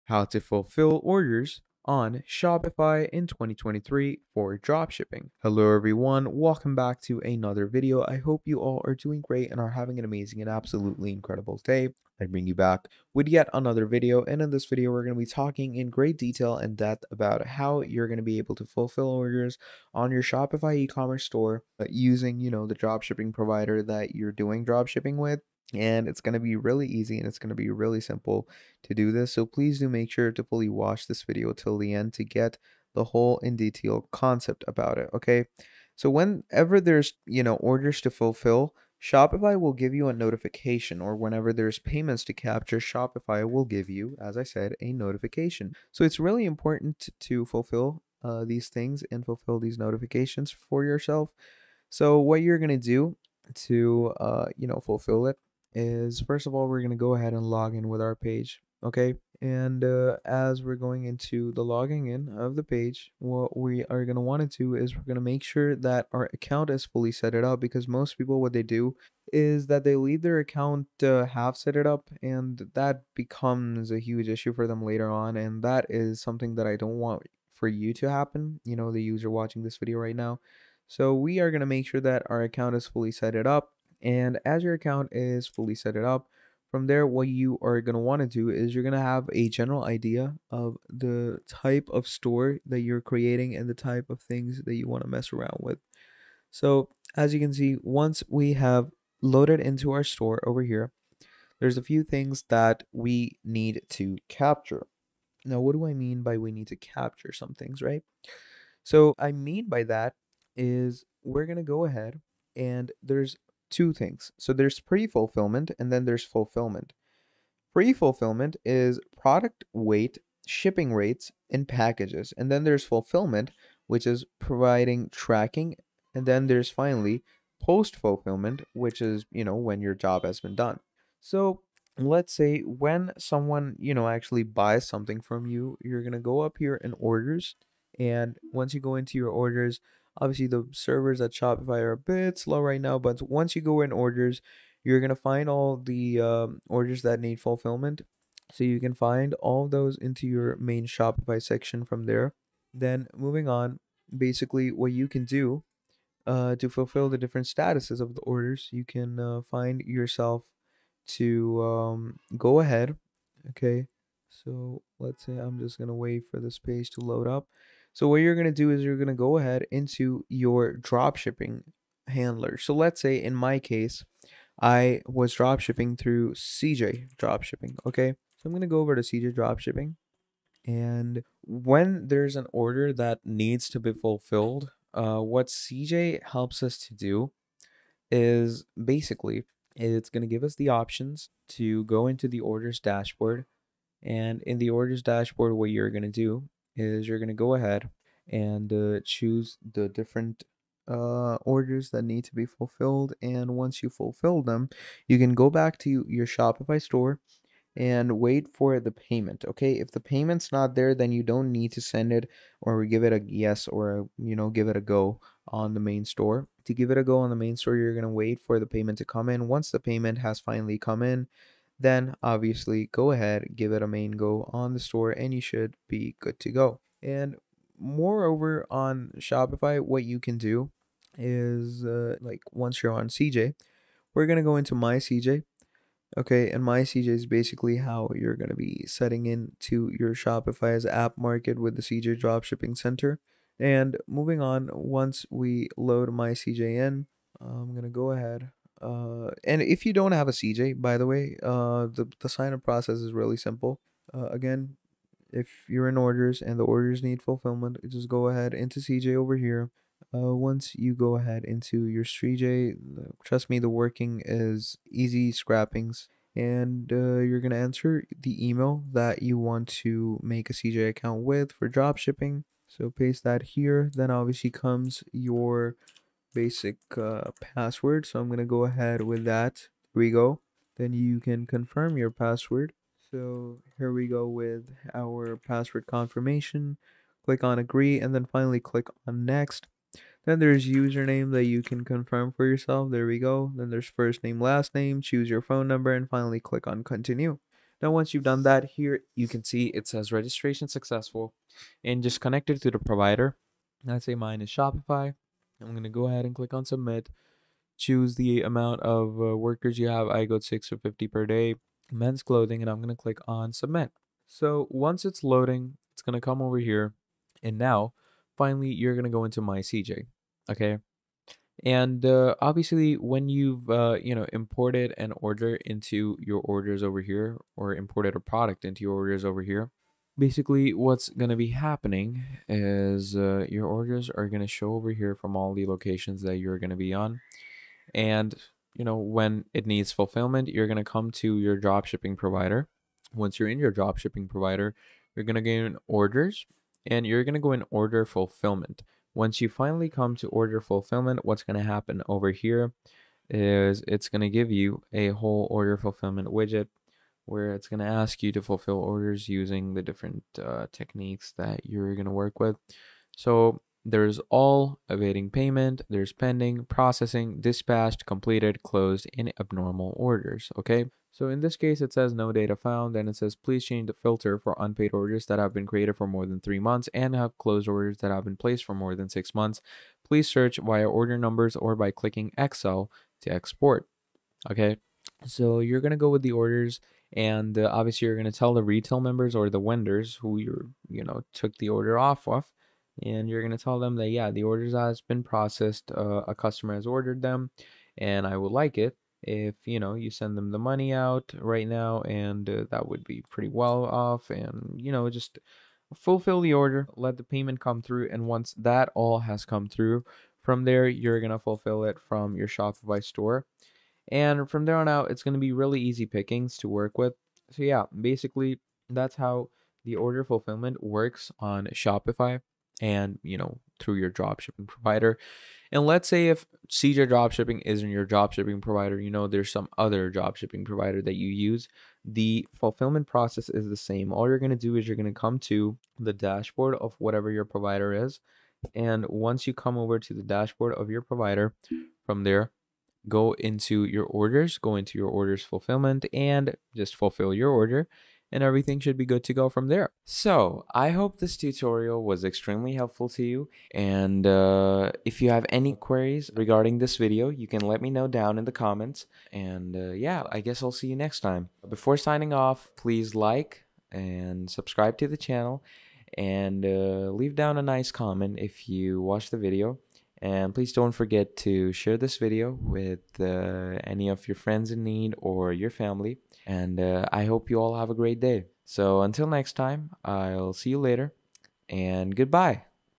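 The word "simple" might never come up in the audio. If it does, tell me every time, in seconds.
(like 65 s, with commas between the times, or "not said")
28 s, 253 s.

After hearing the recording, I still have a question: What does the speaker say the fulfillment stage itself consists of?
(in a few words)
Providing tracking.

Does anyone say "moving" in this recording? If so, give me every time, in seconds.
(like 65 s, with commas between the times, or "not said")
153 s, 244 s.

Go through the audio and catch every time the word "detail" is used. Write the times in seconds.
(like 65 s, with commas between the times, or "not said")
16 s, 33 s.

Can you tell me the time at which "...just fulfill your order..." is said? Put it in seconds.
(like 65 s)
446 s.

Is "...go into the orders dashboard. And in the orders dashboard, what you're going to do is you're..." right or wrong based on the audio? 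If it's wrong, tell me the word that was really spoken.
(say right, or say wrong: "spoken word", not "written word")
right.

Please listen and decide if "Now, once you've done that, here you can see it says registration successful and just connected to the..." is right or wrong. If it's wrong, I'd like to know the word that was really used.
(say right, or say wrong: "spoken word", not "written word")
right.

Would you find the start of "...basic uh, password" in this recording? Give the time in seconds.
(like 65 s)
276 s.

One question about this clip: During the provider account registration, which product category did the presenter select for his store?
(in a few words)
Men's clothing.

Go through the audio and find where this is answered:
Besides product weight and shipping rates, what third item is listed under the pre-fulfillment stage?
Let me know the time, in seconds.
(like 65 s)
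121 s.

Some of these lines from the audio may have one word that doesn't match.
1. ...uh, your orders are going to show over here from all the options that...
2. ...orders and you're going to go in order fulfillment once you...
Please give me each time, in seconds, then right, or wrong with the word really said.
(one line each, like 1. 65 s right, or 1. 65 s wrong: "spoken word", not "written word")
1. 333 s wrong: "locations", not "options"
2. 345 s right.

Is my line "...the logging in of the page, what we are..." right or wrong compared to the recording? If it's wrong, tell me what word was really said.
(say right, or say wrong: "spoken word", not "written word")
right.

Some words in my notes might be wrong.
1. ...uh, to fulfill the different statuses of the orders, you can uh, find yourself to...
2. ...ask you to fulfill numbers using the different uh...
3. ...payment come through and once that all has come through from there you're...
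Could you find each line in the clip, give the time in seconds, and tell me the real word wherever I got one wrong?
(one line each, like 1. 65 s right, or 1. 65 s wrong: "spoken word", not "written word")
1. 156 s right
2. 357 s wrong: "orders", not "numbers"
3. 407 s right.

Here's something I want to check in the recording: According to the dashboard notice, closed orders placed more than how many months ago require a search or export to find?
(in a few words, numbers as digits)
6 months.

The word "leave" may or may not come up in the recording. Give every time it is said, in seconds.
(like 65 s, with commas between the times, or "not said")
69 s, 467 s.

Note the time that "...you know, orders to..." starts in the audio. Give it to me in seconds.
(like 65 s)
37 s.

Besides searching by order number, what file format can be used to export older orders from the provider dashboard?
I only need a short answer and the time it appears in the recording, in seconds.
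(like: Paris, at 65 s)
Excel, at 382 s.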